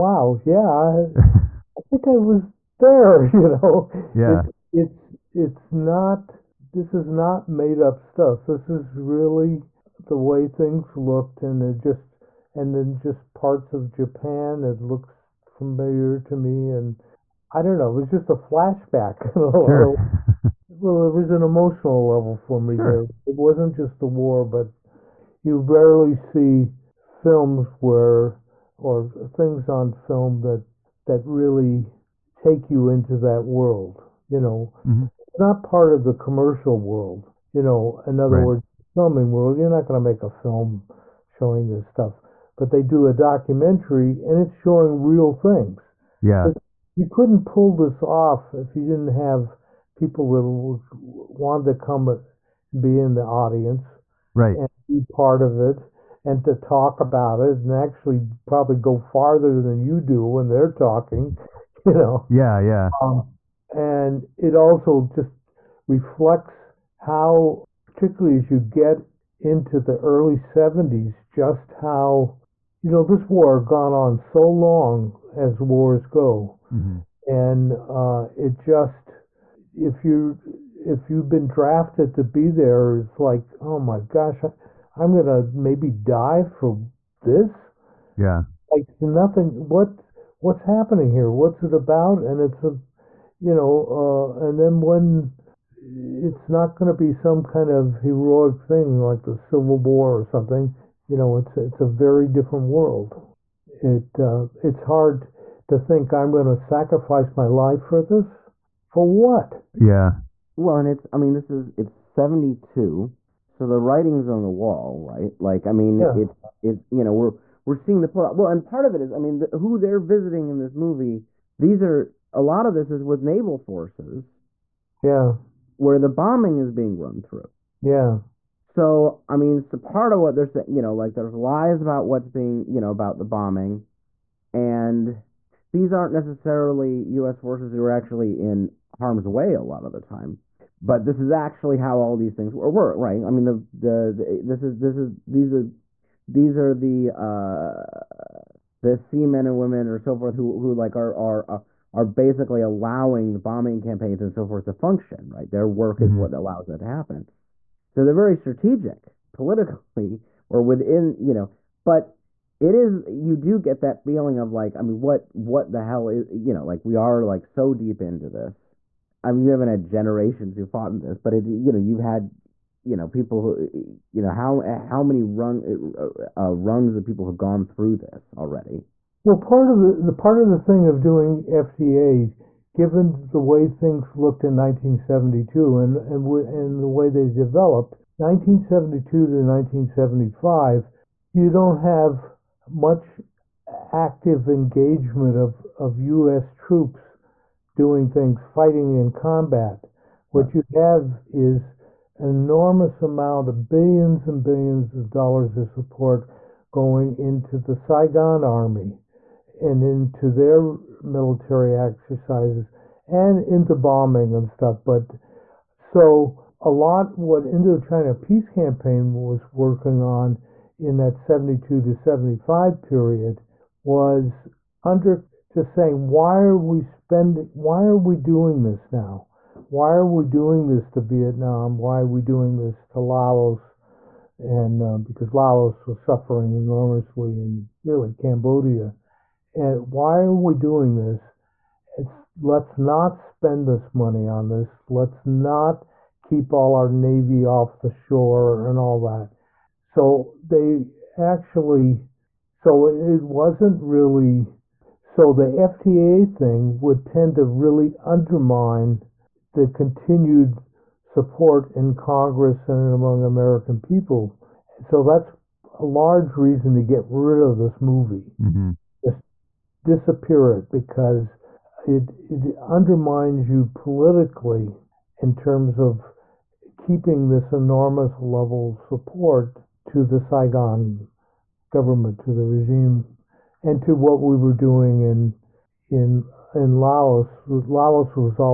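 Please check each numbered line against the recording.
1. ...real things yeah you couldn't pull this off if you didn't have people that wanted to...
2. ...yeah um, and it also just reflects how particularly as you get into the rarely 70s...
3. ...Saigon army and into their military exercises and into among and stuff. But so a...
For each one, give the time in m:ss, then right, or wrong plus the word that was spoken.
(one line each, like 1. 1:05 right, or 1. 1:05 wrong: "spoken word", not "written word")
1. 0:45 right
2. 1:02 wrong: "early", not "rarely"
3. 3:27 wrong: "bombing", not "among".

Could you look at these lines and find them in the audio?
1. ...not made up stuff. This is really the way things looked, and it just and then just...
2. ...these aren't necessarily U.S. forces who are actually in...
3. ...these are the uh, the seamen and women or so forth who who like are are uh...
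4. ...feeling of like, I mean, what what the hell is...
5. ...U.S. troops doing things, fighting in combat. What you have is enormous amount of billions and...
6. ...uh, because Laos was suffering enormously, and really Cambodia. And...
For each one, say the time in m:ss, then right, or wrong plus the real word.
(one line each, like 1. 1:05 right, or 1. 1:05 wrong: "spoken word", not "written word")
1. 0:07 right
2. 2:15 right
3. 2:26 right
4. 2:44 right
5. 3:15 right
6. 3:54 right.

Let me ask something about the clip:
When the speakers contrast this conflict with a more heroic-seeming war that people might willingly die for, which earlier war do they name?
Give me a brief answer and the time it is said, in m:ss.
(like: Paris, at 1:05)
Civil War, at 1:39.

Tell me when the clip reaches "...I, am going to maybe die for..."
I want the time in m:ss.
1:24.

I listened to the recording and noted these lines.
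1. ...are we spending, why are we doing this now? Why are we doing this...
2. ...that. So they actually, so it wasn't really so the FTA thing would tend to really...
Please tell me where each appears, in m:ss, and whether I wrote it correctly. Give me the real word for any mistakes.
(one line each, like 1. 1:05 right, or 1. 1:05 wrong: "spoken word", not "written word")
1. 3:46 right
2. 4:09 right.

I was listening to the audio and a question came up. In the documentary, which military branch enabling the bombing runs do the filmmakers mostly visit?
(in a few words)
Naval forces.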